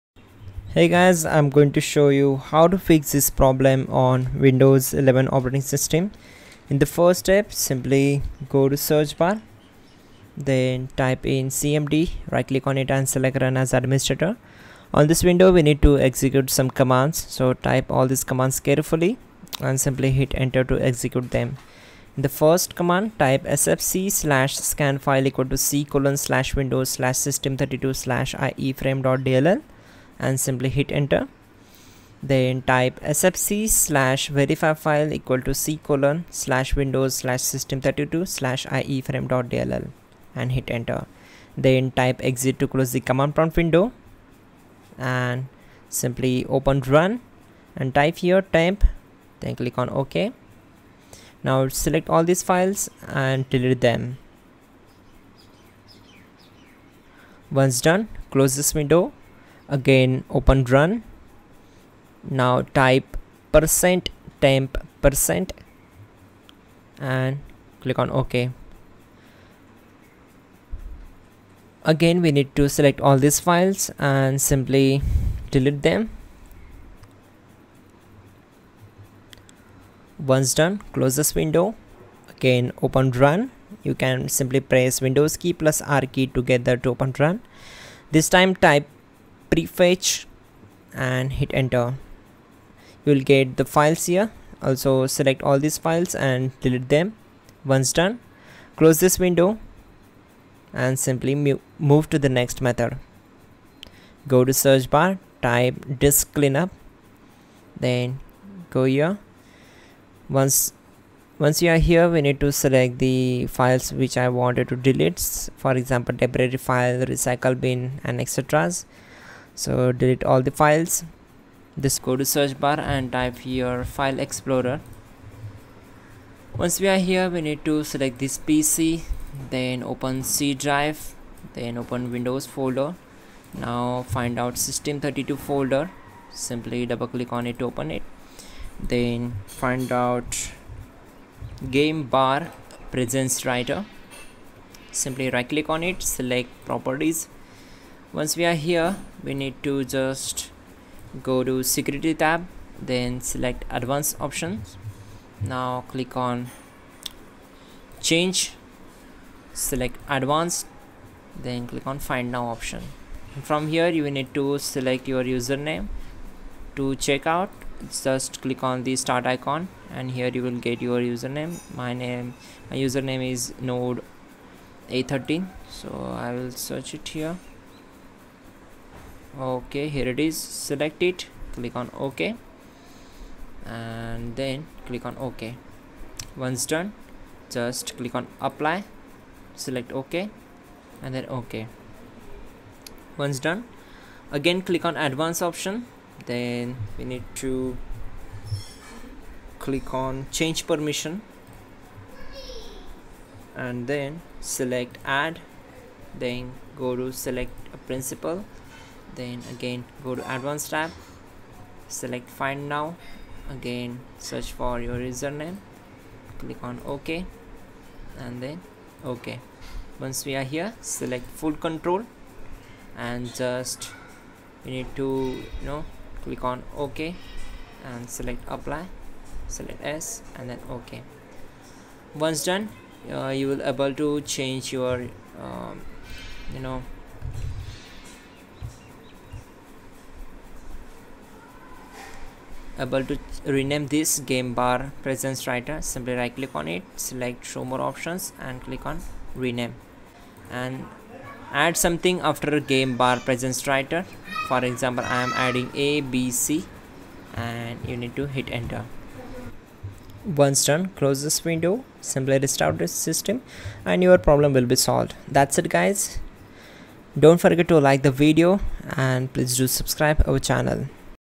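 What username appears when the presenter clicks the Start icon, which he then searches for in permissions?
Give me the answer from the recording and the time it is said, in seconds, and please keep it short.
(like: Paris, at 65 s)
node a13, at 173 s.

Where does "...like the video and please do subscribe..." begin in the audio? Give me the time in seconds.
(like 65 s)
267 s.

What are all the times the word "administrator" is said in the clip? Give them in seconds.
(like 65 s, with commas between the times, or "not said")
13 s.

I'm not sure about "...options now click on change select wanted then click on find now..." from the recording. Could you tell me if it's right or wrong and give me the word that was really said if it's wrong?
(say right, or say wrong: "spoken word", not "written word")
wrong: "advanced", not "wanted".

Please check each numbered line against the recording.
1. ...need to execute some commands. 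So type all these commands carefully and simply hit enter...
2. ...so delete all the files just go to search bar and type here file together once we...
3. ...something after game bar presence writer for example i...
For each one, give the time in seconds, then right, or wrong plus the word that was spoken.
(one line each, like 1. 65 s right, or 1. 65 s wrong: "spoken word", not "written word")
1. 15 s right
2. 119 s wrong: "explorer", not "together"
3. 251 s right.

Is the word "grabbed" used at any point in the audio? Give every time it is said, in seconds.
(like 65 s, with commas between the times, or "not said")
not said.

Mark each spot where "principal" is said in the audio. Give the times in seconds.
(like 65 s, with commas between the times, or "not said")
207 s.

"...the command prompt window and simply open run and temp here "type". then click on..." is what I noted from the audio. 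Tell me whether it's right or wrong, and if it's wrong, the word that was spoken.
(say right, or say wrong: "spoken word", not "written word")
right.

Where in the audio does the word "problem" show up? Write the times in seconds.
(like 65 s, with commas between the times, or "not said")
3 s, 264 s.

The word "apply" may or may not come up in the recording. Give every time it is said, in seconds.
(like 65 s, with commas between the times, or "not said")
188 s, 228 s.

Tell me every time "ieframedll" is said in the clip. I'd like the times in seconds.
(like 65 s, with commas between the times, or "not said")
28 s, 38 s.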